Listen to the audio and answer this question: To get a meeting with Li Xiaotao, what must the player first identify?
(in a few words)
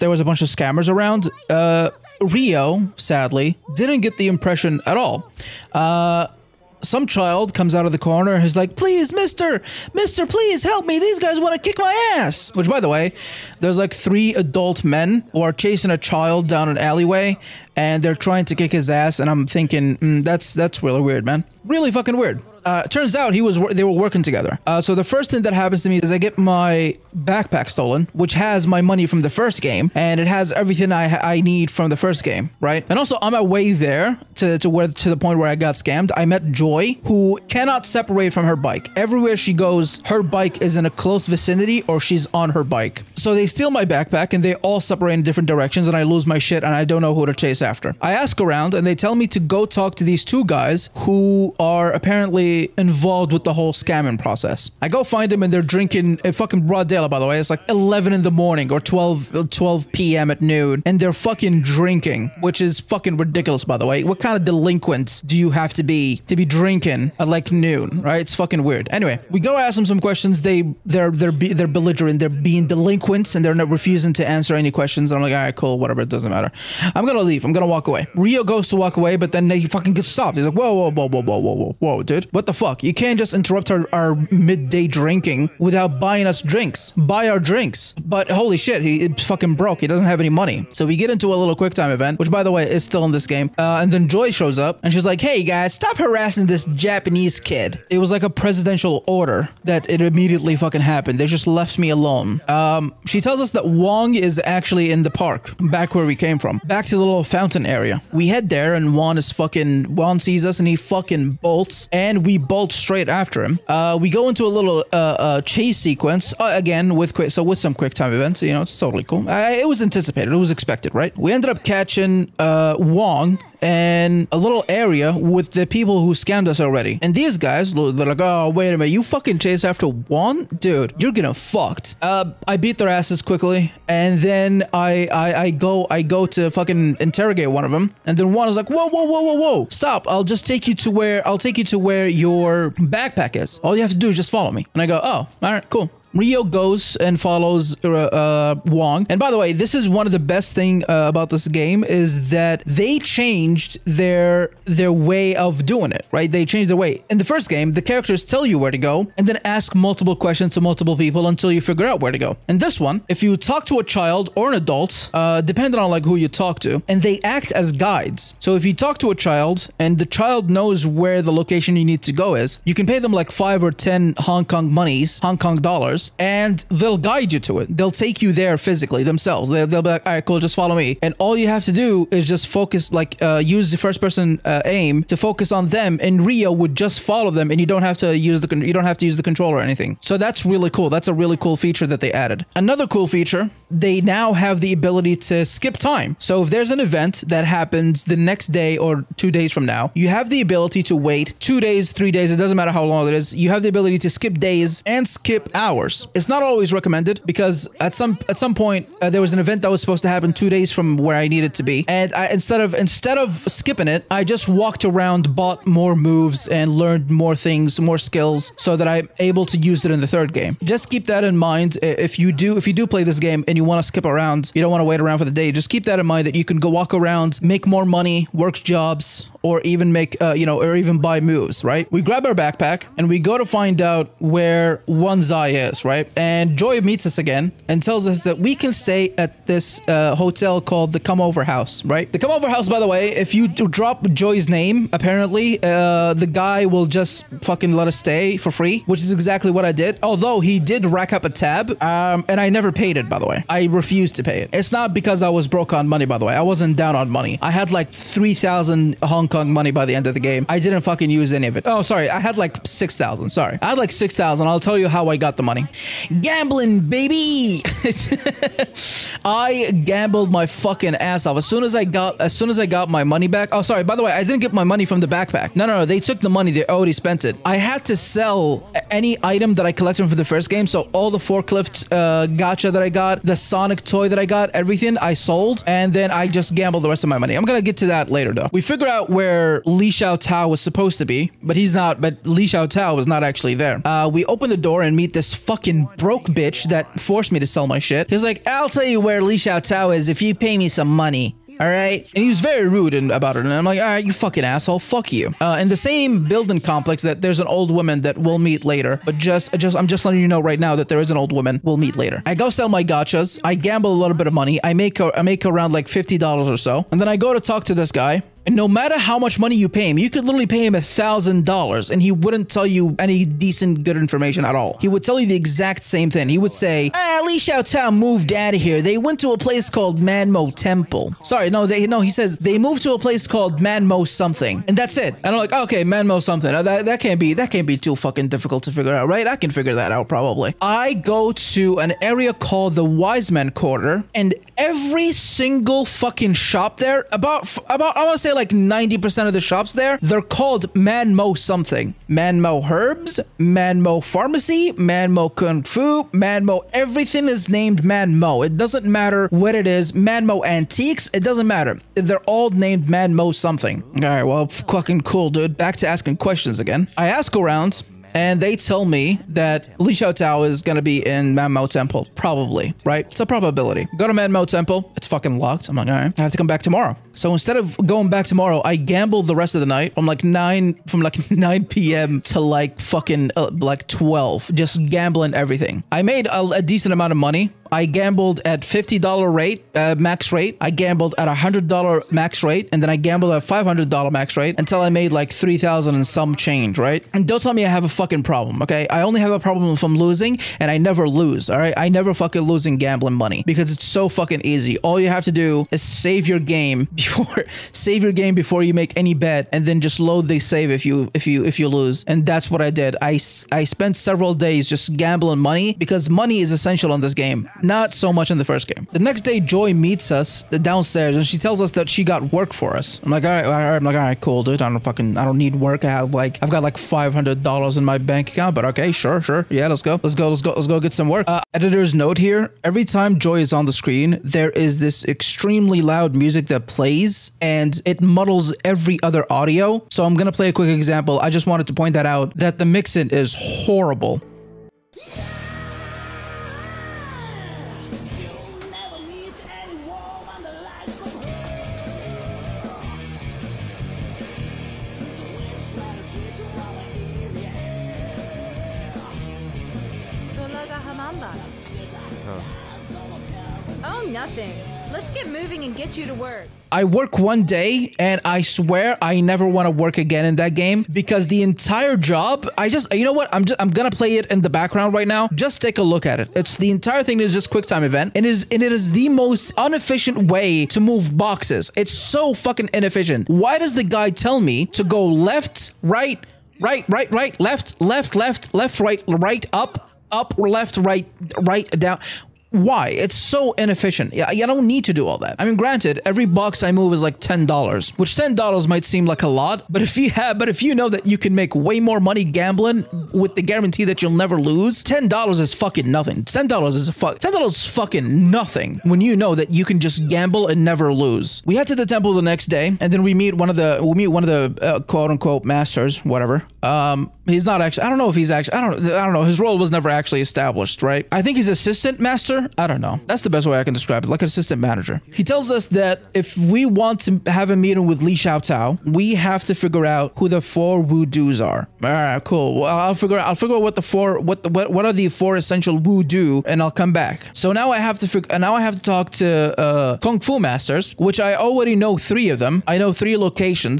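The four wudus.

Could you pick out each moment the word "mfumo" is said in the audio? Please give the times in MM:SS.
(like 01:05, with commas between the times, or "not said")
not said.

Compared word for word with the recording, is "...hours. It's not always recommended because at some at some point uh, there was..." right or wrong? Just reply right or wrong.
right.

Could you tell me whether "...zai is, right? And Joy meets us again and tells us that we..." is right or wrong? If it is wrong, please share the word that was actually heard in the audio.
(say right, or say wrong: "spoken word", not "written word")
right.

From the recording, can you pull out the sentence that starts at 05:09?
But just, just, I'm just letting you know right now that there is an old woman we'll meet later.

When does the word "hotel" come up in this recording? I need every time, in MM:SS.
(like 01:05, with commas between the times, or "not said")
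04:00.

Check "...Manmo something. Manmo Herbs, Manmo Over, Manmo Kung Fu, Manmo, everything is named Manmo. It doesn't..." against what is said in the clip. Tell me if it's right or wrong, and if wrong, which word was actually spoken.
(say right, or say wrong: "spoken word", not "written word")
wrong: "Pharmacy", not "Over".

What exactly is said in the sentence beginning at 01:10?
They, they're, they're, be, they're belligerent.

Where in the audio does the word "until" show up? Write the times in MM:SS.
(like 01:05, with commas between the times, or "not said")
02:41, 06:34.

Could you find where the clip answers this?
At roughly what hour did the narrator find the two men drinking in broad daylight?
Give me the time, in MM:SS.
00:57.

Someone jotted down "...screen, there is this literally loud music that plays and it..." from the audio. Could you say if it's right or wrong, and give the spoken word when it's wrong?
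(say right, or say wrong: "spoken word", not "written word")
wrong: "extremely", not "literally".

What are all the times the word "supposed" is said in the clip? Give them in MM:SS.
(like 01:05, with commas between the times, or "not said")
03:29, 04:50.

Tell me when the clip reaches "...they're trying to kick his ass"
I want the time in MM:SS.
00:18.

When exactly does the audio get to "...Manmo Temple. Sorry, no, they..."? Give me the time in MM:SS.
05:30.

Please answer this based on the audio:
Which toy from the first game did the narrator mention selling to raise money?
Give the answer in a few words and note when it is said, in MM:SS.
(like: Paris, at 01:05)
Sonic toy, at 04:43.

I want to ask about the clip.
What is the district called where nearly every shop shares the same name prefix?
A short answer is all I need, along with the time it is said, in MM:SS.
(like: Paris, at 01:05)
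Wise Man Quarter, at 05:42.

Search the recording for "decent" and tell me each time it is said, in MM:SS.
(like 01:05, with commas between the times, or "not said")
05:23, 06:26.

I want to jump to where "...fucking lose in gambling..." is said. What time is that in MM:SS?
06:42.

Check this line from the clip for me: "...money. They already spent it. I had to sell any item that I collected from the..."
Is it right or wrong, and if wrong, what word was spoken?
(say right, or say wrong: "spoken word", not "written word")
right.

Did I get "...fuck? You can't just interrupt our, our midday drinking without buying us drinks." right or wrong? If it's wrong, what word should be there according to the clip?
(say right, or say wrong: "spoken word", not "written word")
right.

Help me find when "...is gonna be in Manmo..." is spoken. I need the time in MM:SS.
06:10.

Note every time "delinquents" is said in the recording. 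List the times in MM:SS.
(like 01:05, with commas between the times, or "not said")
01:04, 01:12.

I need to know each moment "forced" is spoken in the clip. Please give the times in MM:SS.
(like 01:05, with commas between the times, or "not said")
04:57.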